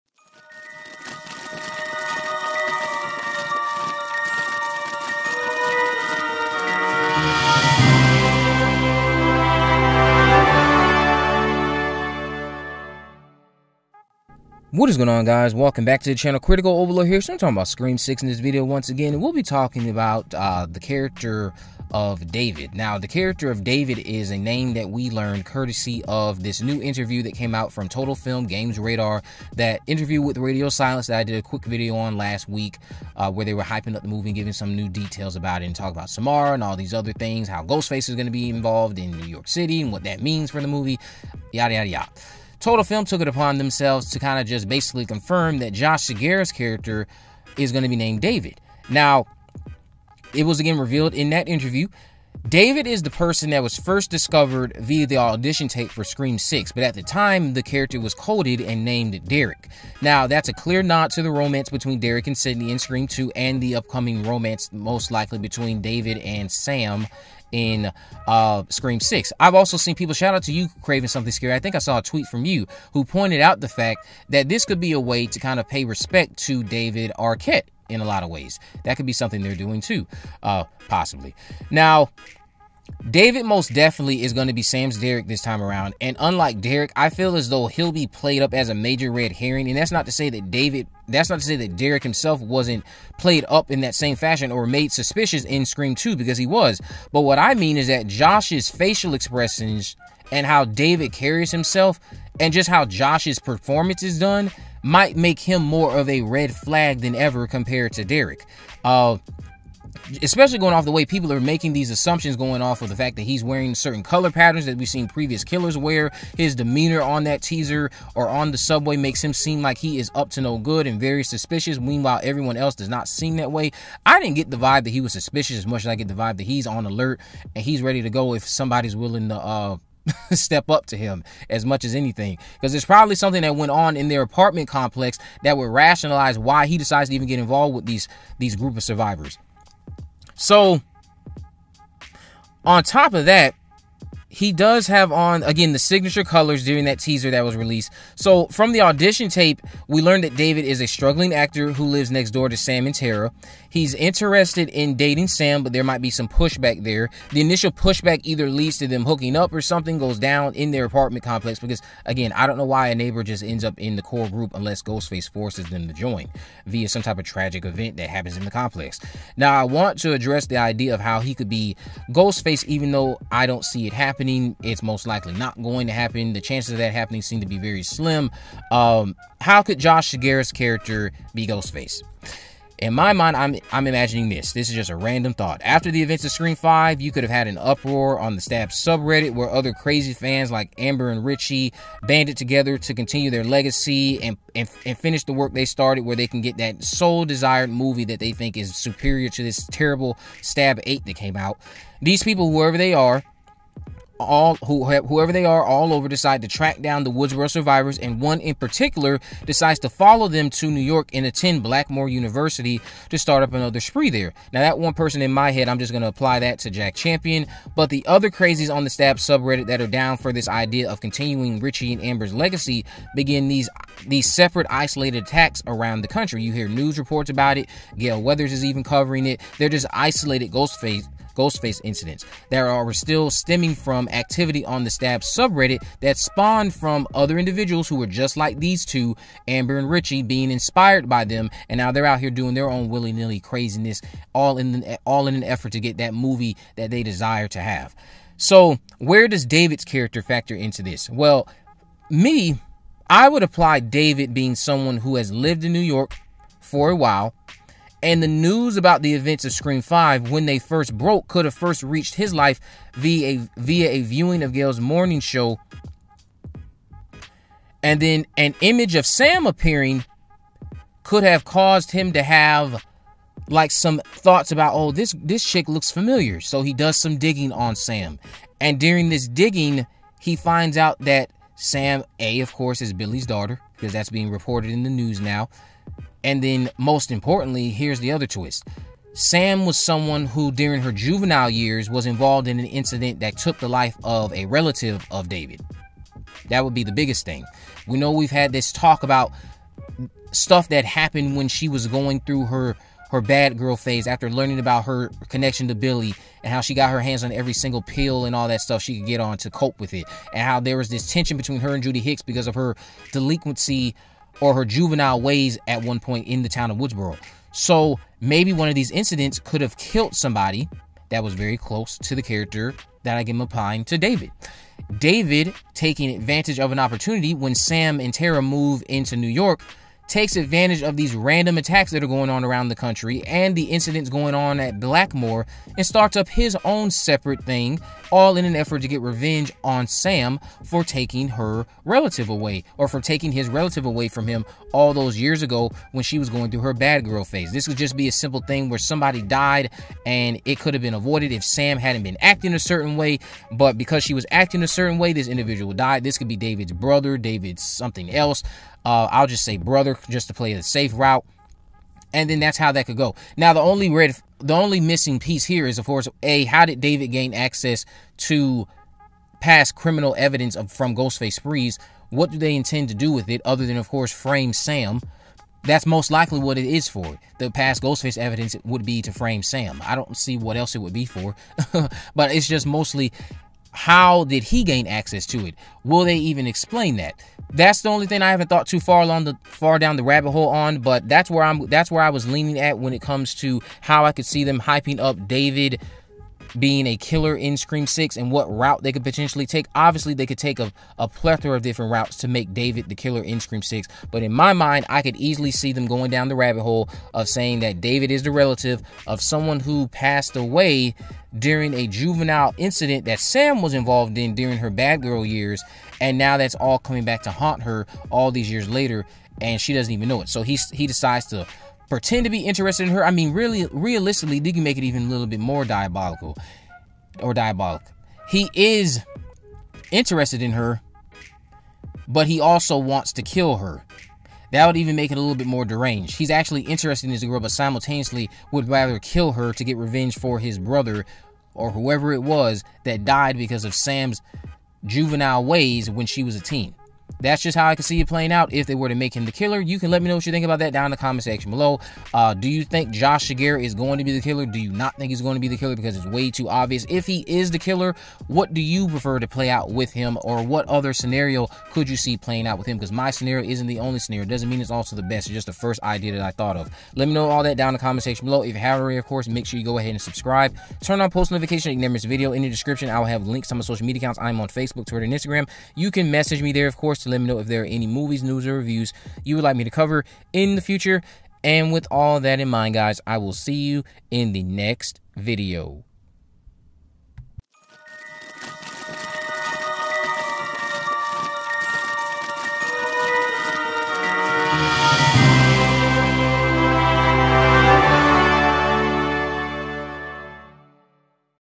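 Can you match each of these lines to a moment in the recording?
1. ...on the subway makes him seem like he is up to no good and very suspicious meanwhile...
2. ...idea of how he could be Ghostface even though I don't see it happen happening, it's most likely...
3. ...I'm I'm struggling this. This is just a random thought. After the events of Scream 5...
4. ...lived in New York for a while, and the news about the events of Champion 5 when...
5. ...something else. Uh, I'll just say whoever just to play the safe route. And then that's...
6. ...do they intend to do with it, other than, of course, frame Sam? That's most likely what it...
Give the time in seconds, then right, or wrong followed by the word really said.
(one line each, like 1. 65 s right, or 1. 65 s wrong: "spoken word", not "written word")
1. 118 s right
2. 170 s right
3. 183 s wrong: "imagining", not "struggling"
4. 255 s wrong: "Scream", not "Champion"
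5. 357 s wrong: "brother", not "whoever"
6. 372 s right.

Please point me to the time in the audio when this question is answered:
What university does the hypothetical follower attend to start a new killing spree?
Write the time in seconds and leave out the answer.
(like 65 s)
211 s.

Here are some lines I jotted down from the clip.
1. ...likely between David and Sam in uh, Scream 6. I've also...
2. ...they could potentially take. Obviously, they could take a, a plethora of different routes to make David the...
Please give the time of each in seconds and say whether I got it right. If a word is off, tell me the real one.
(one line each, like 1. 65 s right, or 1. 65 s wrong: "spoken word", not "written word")
1. 65 s right
2. 398 s right.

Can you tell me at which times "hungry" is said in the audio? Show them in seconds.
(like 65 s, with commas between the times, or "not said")
not said.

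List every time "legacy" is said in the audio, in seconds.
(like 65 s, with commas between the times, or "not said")
193 s, 222 s.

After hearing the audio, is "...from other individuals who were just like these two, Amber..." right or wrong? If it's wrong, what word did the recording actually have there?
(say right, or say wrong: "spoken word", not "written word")
right.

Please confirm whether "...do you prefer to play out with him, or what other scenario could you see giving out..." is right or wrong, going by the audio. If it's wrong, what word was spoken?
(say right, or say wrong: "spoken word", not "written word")
wrong: "playing", not "giving".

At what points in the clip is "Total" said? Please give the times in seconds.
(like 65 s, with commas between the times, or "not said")
27 s, 42 s.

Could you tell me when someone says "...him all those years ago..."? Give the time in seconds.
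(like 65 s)
344 s.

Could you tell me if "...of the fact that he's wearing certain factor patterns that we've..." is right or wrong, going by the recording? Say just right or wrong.
wrong.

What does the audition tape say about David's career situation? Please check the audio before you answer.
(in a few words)
Struggling actor.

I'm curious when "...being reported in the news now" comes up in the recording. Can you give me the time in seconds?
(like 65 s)
284 s.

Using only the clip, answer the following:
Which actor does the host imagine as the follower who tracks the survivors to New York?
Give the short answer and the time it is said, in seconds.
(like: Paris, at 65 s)
Jack Champion, at 216 s.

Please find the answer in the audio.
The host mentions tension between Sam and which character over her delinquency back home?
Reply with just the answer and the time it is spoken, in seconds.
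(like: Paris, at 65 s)
Judy Hicks, at 311 s.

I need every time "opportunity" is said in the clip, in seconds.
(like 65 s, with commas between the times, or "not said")
326 s.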